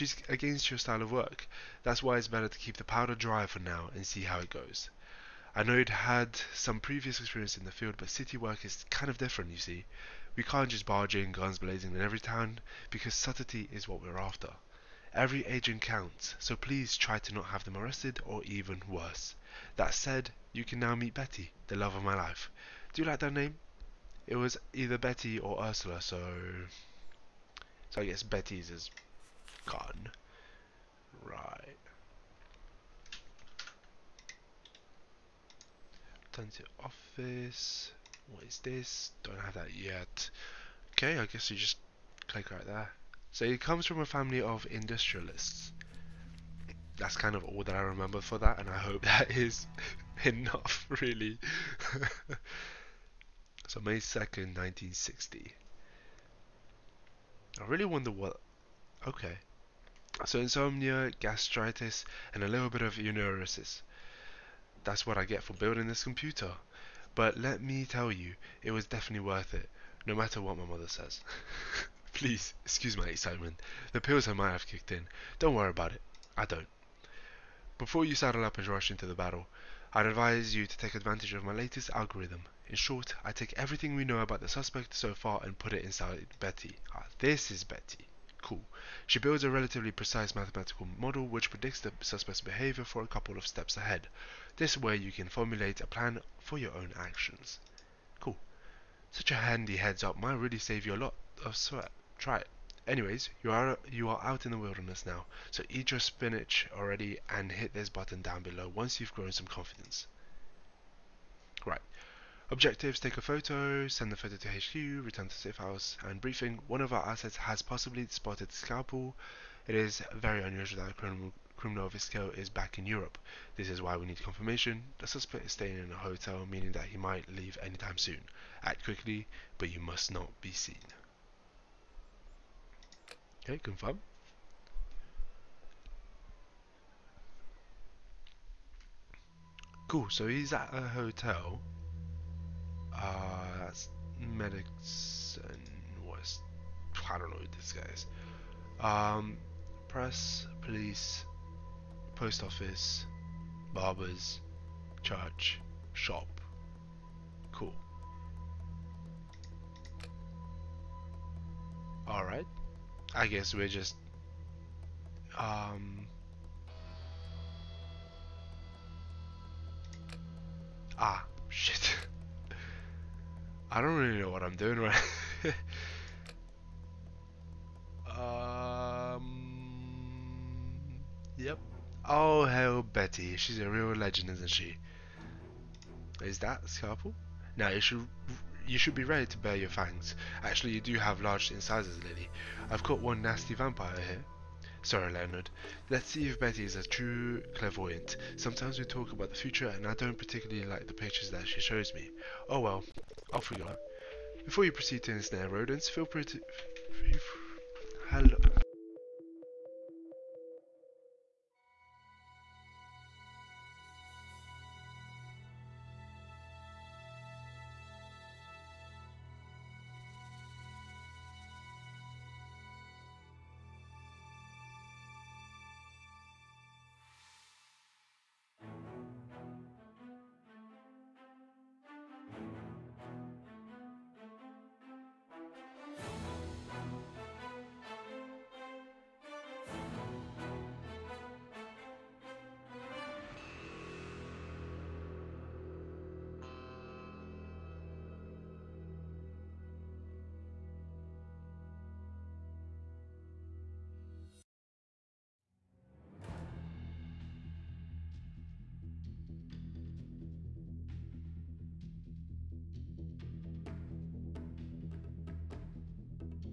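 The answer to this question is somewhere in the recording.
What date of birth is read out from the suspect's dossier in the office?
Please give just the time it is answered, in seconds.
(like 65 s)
53 s.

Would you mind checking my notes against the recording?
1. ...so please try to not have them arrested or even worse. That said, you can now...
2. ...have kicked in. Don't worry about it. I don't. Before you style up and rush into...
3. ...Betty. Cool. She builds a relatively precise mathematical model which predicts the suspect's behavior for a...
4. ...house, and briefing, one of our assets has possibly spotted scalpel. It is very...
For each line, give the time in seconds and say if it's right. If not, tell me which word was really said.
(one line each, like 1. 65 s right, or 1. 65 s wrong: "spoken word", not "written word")
1. 16 s right
2. 74 s wrong: "saddle", not "style"
3. 87 s right
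4. 115 s right.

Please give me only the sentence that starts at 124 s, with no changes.
The suspect is staying in a hotel, meaning that he might leave anytime soon.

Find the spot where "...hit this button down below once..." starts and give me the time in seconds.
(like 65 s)
107 s.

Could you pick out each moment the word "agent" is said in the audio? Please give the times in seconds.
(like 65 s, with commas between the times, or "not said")
15 s.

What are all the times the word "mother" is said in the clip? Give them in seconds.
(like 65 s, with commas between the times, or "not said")
70 s.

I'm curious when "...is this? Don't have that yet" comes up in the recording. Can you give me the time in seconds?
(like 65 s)
38 s.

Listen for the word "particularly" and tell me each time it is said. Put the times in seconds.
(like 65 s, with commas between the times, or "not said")
200 s.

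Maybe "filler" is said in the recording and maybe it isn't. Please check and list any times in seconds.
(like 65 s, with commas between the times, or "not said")
not said.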